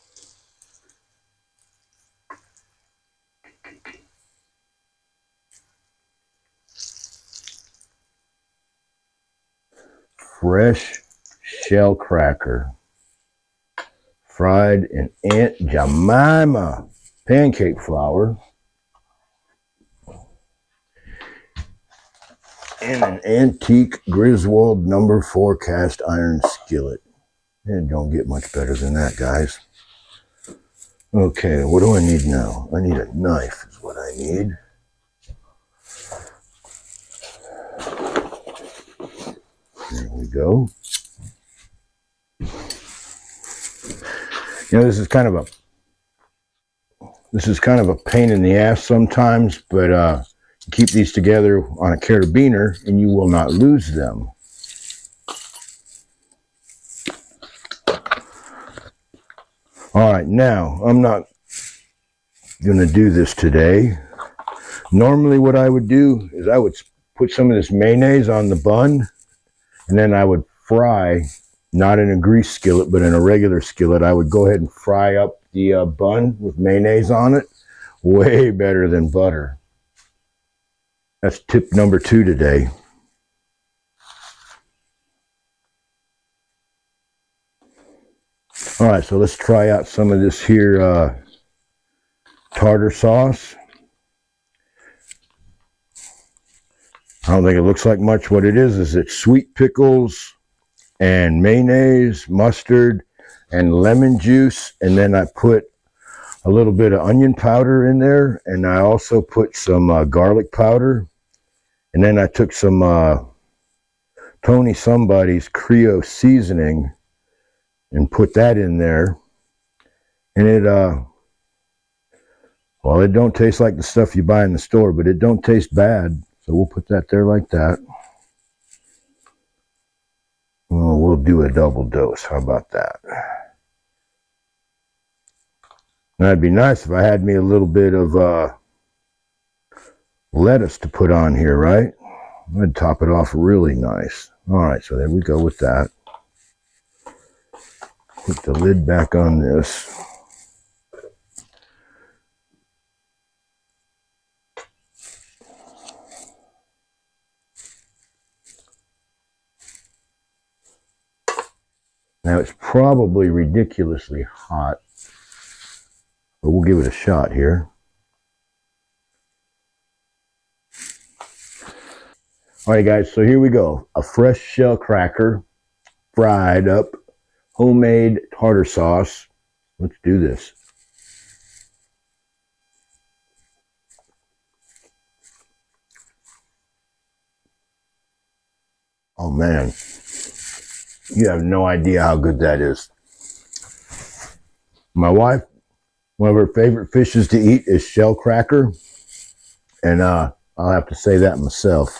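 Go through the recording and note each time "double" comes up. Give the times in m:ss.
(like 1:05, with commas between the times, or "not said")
2:11.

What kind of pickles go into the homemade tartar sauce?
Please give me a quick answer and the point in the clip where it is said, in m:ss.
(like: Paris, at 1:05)
Sweet pickles, at 1:39.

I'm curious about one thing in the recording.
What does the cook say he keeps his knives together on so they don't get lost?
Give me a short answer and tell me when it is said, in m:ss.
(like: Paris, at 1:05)
A carabiner, at 0:51.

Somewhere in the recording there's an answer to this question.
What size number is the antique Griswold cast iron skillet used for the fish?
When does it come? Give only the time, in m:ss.
0:24.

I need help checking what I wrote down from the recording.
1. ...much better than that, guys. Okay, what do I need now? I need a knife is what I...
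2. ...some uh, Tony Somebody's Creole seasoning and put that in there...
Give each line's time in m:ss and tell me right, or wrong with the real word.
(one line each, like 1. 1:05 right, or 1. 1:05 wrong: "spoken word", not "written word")
1. 0:28 right
2. 1:52 right.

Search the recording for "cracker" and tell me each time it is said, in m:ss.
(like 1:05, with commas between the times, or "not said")
0:11, 2:54, 3:18.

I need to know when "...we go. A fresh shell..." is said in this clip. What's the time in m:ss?
2:53.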